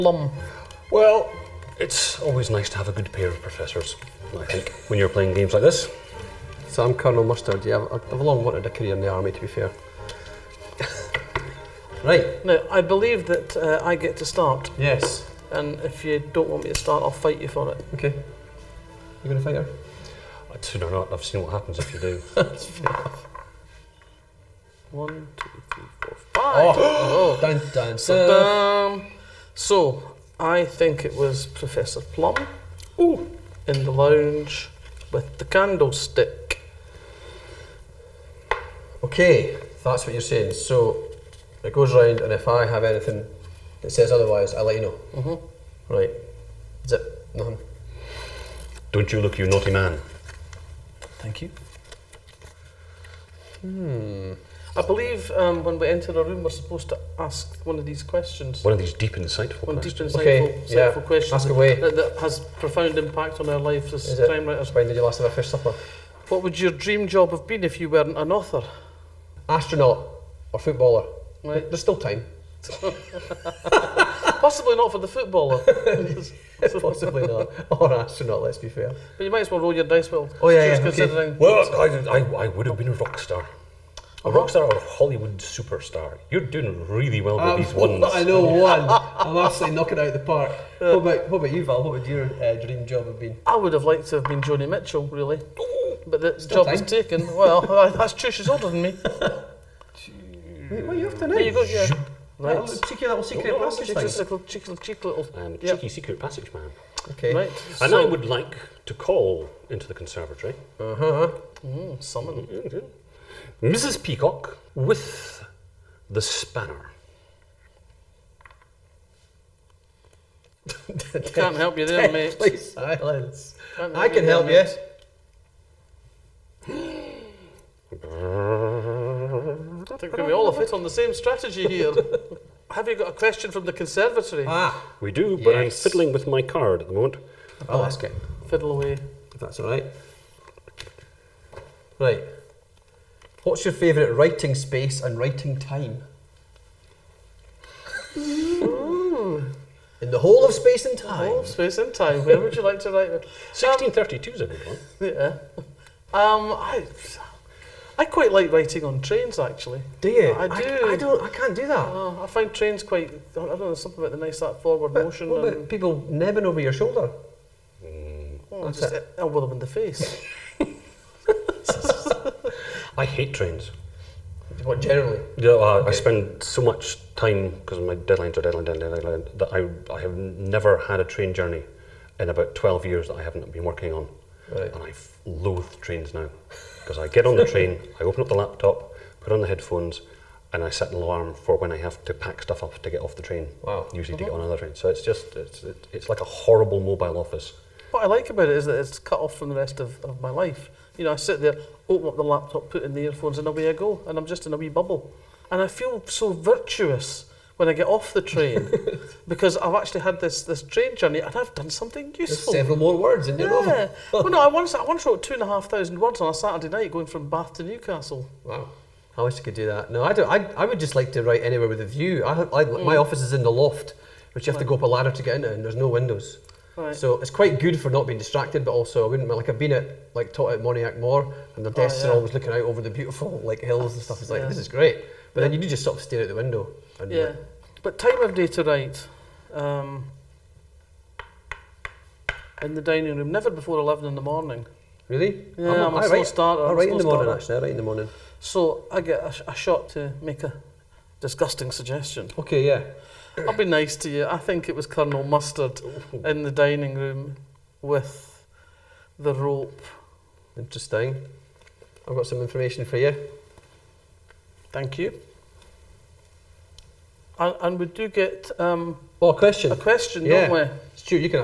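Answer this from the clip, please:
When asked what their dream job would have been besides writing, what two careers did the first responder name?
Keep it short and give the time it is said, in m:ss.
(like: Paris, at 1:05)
Astronaut or footballer, at 1:09.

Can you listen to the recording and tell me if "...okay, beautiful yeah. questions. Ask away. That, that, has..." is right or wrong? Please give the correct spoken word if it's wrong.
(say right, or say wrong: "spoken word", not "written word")
wrong: "insightful", not "beautiful".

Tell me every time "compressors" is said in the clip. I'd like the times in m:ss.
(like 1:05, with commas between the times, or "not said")
not said.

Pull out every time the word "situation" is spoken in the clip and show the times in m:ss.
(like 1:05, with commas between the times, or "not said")
not said.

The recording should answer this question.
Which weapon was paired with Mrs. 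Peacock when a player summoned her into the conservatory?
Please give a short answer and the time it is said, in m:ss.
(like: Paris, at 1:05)
spanner, at 1:56.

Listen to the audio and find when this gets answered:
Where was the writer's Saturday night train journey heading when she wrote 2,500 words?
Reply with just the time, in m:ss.
3:37.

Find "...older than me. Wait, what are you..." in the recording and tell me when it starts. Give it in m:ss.
1:38.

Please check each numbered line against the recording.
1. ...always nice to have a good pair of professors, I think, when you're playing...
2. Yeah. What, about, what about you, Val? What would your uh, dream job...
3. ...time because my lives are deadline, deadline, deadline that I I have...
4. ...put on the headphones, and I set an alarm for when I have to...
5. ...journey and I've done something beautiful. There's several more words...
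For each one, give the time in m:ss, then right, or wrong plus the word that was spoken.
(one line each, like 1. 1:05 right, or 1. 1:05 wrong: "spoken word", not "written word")
1. 0:02 right
2. 1:30 right
3. 2:57 wrong: "deadlines", not "lives"
4. 3:09 right
5. 3:30 wrong: "useful", not "beautiful".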